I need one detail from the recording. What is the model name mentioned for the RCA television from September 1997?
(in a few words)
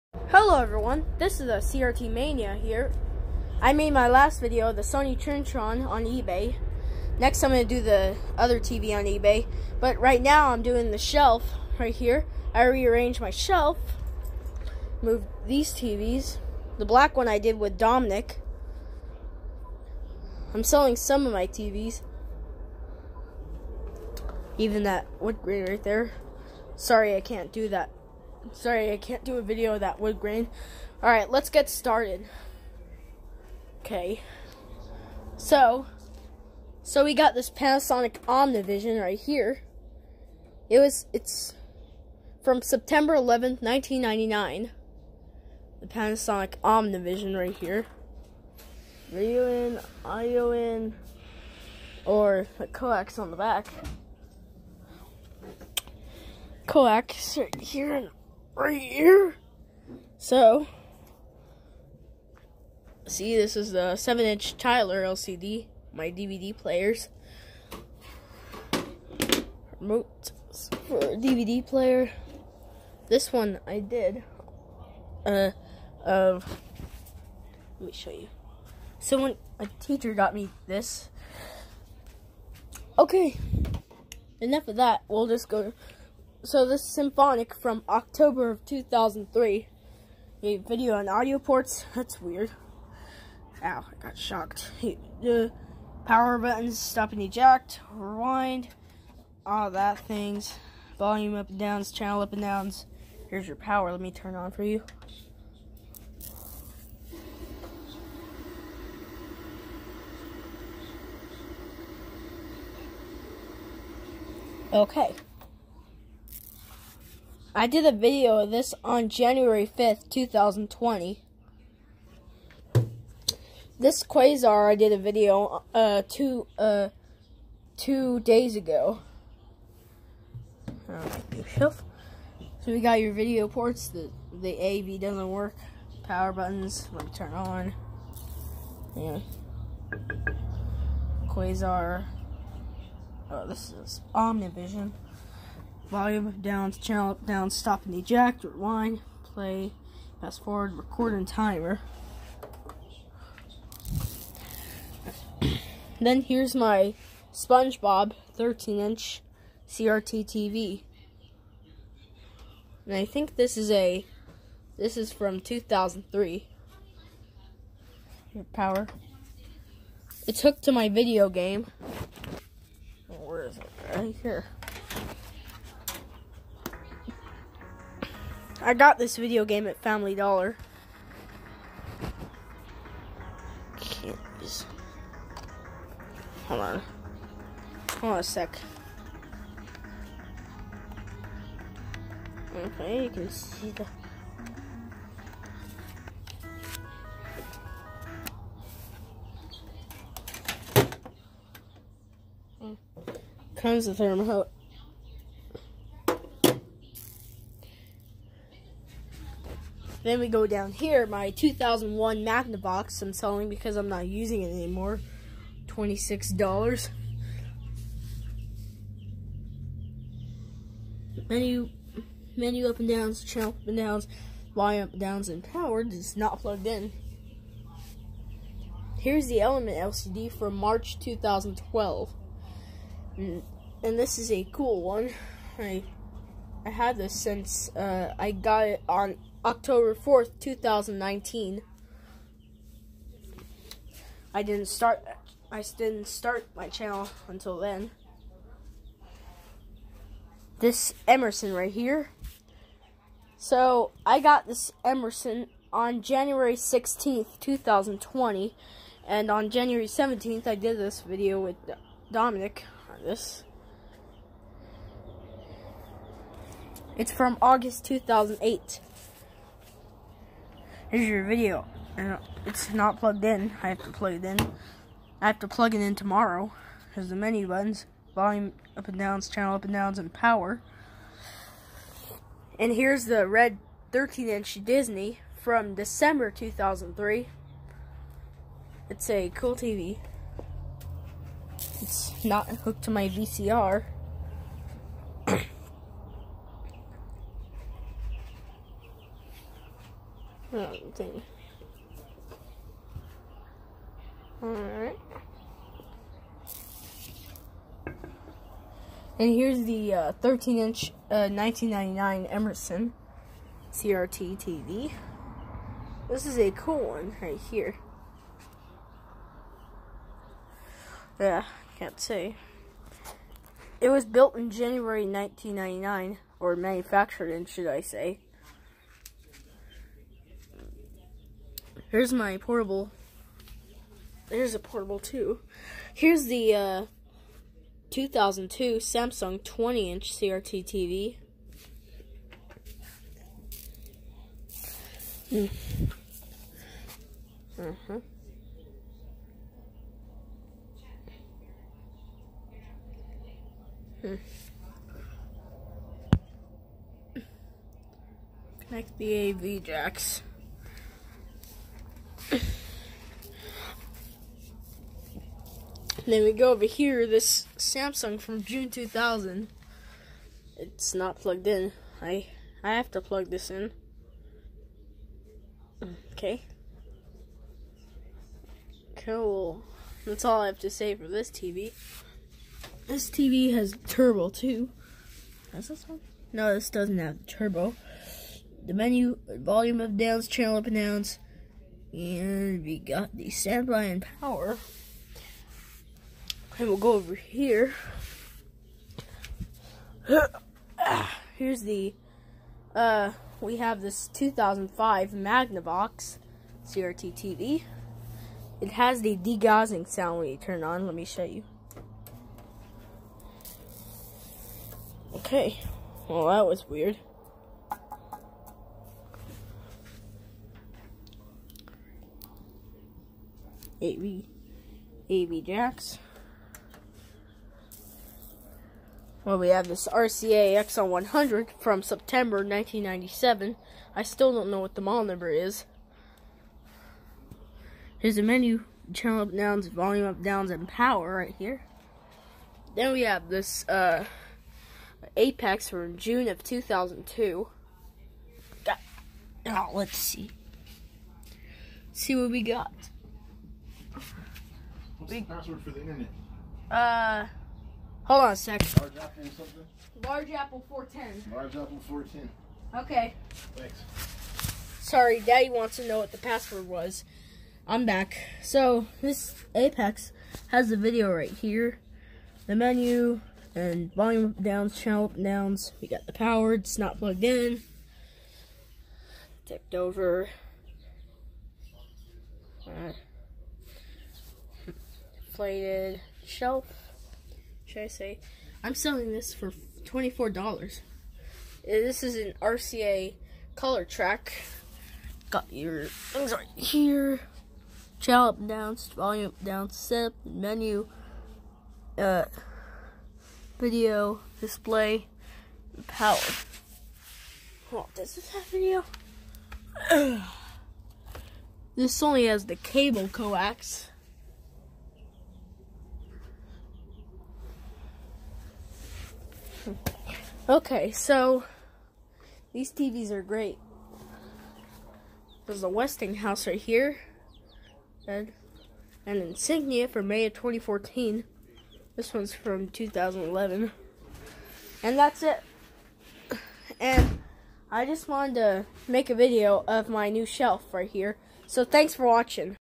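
Exxon 100.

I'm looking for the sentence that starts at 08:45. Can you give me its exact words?
There's a Westinghouse right here, and an insignia for May of 2014.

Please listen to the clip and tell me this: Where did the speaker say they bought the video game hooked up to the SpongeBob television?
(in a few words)
Family Dollar.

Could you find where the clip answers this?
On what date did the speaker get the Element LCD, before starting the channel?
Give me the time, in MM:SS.
03:59.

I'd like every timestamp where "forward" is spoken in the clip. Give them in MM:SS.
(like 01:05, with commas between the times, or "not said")
02:30.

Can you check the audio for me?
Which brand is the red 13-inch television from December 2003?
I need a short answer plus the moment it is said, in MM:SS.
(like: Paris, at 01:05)
Disney, at 04:44.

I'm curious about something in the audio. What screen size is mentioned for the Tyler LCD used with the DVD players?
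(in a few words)
7 inch.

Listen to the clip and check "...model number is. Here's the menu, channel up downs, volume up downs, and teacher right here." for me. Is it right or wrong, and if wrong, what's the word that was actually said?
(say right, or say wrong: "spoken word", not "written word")
wrong: "power", not "teacher".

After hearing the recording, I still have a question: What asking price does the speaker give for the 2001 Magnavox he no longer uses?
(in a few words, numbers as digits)
$26.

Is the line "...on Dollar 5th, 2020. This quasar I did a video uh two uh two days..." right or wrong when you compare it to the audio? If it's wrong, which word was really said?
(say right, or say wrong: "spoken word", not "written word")
wrong: "January", not "Dollar".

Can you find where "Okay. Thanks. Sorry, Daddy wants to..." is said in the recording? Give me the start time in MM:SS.
07:42.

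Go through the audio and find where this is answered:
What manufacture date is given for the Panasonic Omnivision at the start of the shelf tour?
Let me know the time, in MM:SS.
00:42.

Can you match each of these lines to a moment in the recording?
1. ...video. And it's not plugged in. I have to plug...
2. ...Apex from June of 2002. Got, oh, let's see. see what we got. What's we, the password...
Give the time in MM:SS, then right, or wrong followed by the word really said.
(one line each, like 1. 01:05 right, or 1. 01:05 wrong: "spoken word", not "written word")
1. 04:31 right
2. 07:25 right.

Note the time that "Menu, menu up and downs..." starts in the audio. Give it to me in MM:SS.
03:41.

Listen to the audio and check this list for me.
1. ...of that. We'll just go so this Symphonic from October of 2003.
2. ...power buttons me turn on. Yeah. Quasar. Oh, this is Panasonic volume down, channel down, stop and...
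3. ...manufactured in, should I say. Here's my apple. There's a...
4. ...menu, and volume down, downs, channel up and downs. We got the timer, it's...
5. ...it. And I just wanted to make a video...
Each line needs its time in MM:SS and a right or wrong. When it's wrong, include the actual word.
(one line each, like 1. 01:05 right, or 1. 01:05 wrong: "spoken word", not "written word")
1. 01:24 right
2. 02:16 wrong: "Omnivision", not "Panasonic"
3. 05:26 wrong: "portable", not "apple"
4. 07:52 wrong: "power", not "timer"
5. 08:55 right.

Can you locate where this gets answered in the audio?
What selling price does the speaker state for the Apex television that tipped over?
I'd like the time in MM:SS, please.
08:09.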